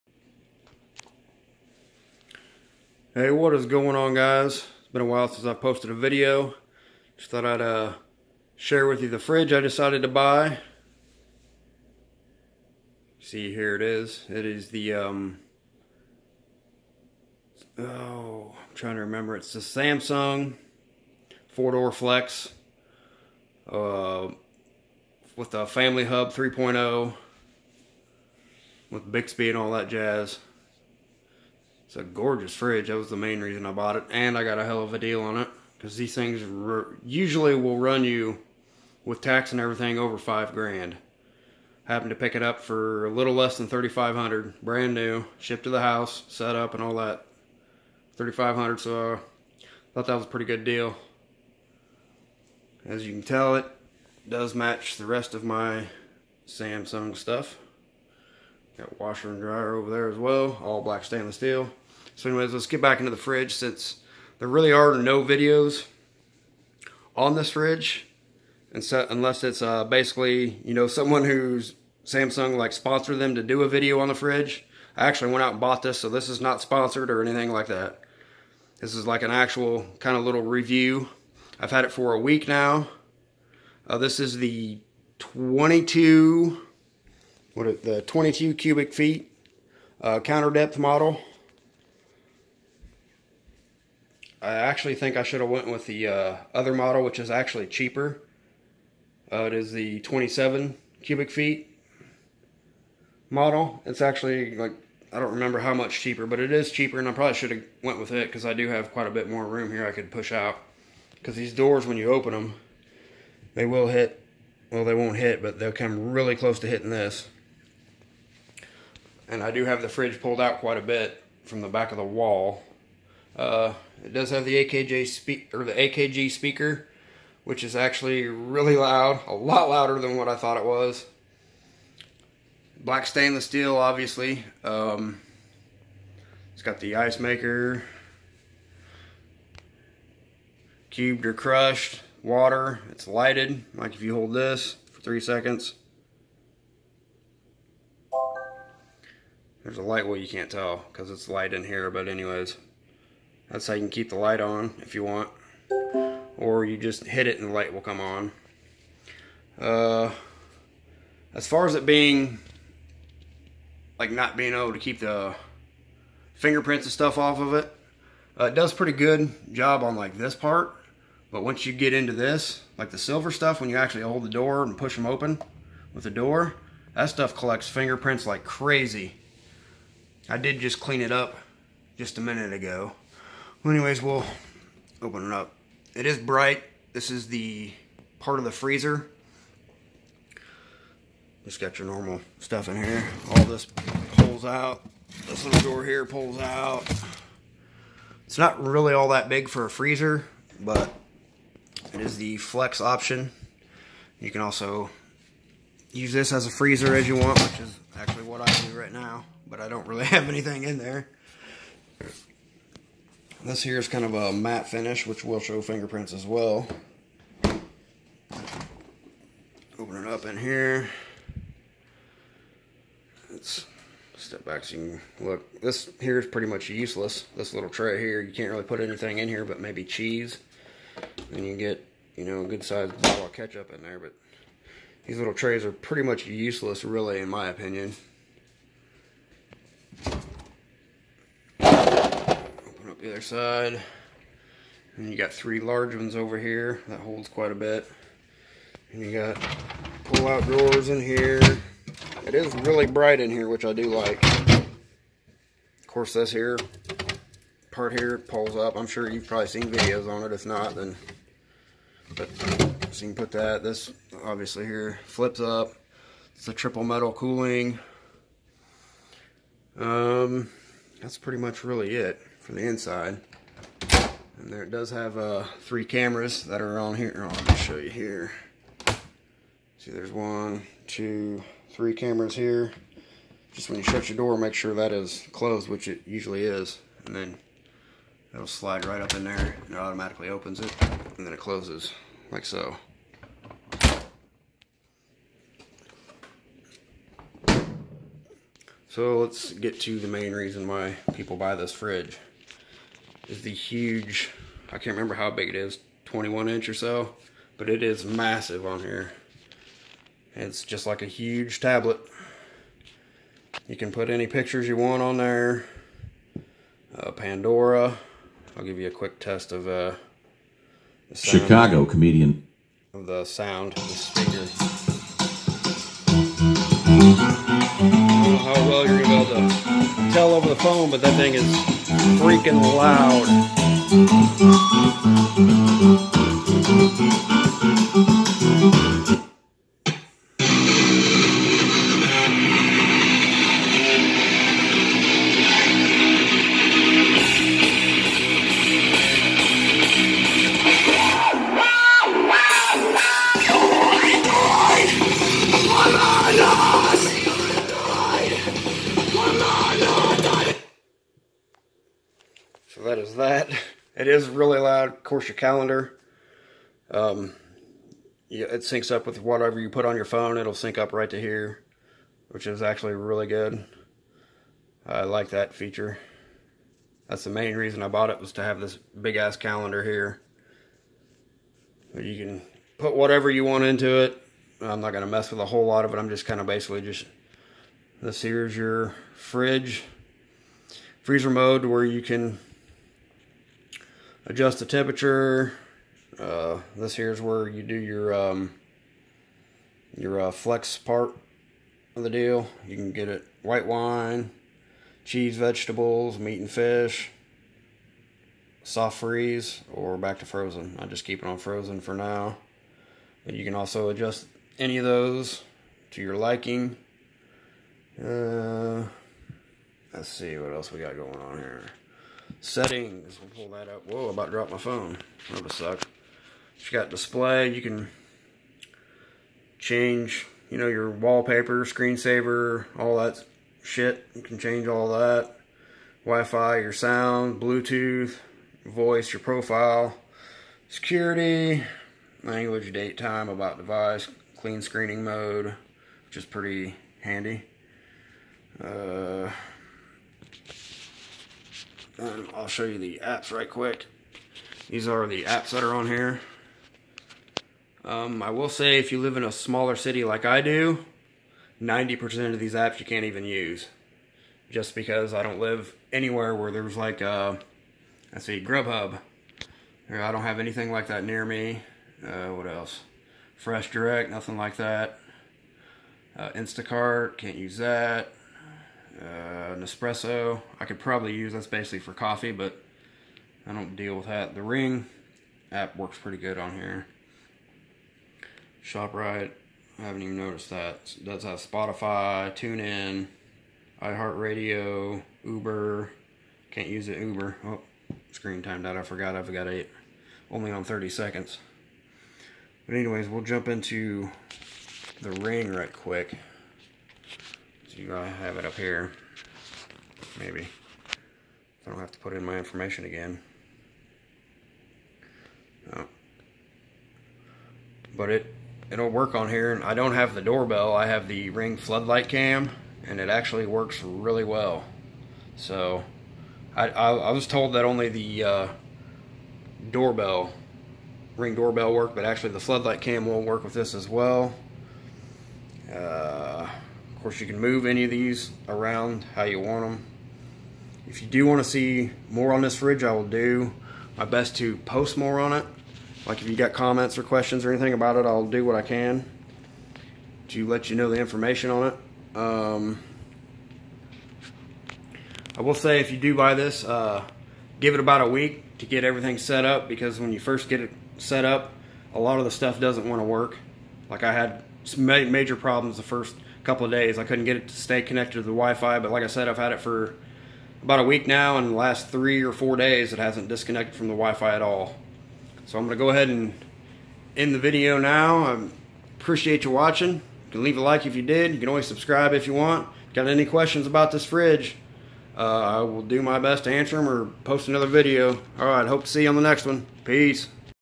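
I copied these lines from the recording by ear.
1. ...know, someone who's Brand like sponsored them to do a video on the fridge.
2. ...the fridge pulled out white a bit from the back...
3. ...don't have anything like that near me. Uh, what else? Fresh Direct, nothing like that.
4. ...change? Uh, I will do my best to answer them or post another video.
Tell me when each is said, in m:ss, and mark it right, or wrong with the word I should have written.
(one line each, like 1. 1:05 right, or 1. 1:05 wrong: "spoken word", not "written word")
1. 1:10 wrong: "Samsung", not "Brand"
2. 1:59 wrong: "quite", not "white"
3. 7:50 right
4. 9:44 wrong: "fridge", not "change".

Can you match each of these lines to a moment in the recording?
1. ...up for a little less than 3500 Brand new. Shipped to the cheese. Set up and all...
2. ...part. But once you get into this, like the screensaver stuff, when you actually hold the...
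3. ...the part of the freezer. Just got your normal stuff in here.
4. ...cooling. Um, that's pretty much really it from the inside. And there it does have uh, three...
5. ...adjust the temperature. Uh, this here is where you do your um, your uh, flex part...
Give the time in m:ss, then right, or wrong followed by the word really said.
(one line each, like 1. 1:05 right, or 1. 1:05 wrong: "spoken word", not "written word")
1. 0:42 wrong: "house", not "cheese"
2. 2:50 wrong: "silver", not "screensaver"
3. 3:07 right
4. 4:27 right
5. 6:34 right.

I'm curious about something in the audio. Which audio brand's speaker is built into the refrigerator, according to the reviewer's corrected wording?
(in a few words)
AKG.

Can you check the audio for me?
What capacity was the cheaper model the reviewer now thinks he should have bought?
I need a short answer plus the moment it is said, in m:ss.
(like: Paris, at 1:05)
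27 cubic feet, at 1:39.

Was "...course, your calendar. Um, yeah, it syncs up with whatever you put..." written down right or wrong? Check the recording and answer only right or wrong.
right.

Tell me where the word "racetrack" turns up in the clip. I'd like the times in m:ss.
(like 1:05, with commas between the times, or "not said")
not said.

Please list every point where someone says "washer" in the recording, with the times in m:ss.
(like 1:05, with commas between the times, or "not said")
0:58.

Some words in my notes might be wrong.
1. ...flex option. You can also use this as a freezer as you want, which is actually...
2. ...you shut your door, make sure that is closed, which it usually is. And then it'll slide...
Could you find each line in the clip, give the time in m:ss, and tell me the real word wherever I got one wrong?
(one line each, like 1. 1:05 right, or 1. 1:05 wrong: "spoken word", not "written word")
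1. 3:22 right
2. 4:43 right.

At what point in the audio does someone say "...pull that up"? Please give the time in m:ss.
7:03.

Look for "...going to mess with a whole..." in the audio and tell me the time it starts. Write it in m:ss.
6:24.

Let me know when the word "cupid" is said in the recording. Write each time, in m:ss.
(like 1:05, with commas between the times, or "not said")
not said.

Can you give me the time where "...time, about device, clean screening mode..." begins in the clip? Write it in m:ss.
7:22.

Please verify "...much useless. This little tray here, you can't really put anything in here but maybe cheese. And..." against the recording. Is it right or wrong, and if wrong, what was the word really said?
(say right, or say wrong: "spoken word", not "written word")
right.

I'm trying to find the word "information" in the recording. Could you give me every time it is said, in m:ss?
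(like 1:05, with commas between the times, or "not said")
8:32, 9:10.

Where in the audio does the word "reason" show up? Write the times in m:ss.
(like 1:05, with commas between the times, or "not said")
0:33, 5:00, 6:17.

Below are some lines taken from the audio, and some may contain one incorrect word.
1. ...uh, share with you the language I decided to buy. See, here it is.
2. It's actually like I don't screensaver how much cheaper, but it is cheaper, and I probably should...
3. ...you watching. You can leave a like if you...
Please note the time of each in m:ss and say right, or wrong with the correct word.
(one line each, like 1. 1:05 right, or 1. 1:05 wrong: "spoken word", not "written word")
1. 0:07 wrong: "fridge", not "language"
2. 1:43 wrong: "remember", not "screensaver"
3. 9:39 right.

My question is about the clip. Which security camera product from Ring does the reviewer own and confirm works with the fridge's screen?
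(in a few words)
Ring floodlight cam.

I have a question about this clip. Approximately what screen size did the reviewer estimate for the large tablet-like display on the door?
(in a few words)
21 inch.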